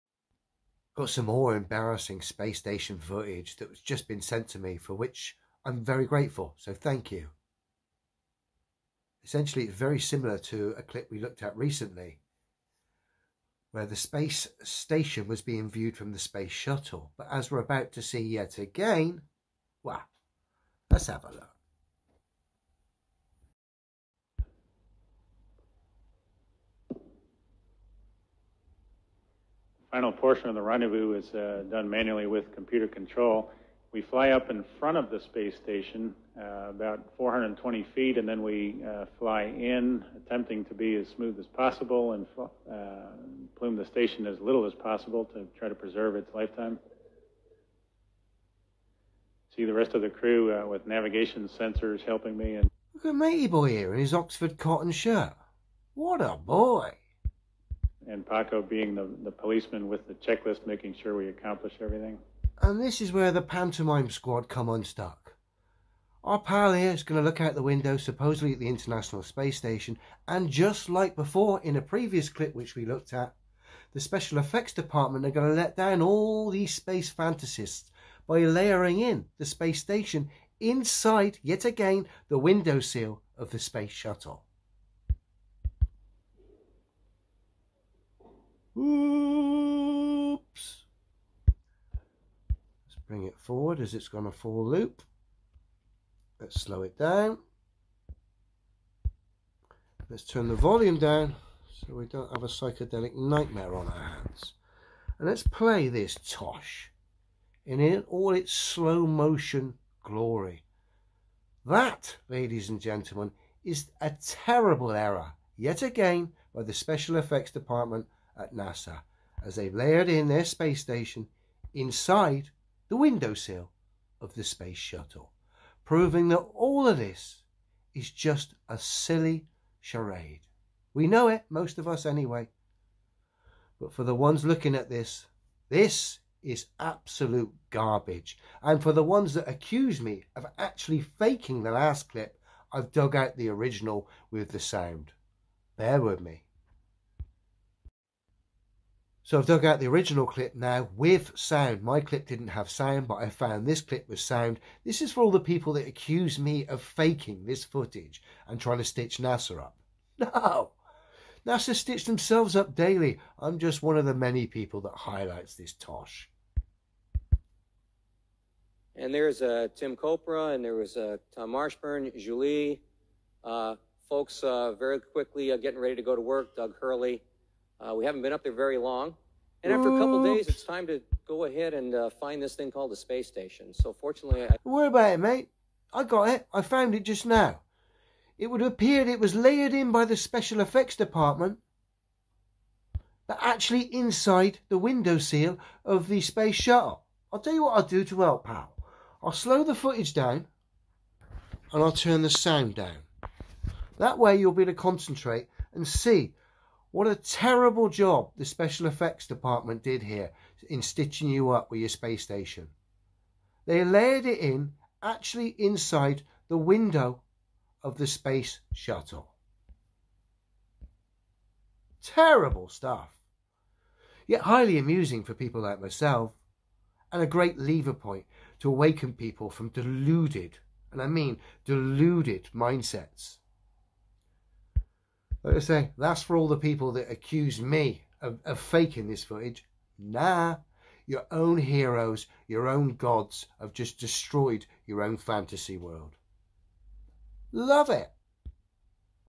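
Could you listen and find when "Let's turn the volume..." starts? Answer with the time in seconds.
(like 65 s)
100 s.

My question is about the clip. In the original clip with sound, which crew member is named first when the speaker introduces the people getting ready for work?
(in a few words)
Tim Kopra.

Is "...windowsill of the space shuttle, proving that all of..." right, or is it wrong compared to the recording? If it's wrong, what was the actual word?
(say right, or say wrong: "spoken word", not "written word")
right.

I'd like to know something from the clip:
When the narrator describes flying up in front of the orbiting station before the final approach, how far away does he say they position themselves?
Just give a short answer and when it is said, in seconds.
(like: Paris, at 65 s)
420 feet, at 37 s.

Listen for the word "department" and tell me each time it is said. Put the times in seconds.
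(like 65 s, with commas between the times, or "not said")
74 s, 117 s, 190 s, 209 s.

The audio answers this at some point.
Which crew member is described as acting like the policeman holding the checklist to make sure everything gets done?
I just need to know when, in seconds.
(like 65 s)
58 s.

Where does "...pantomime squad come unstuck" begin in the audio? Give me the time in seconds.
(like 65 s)
63 s.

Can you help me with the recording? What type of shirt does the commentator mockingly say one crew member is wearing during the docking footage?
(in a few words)
Oxford cotton shirt.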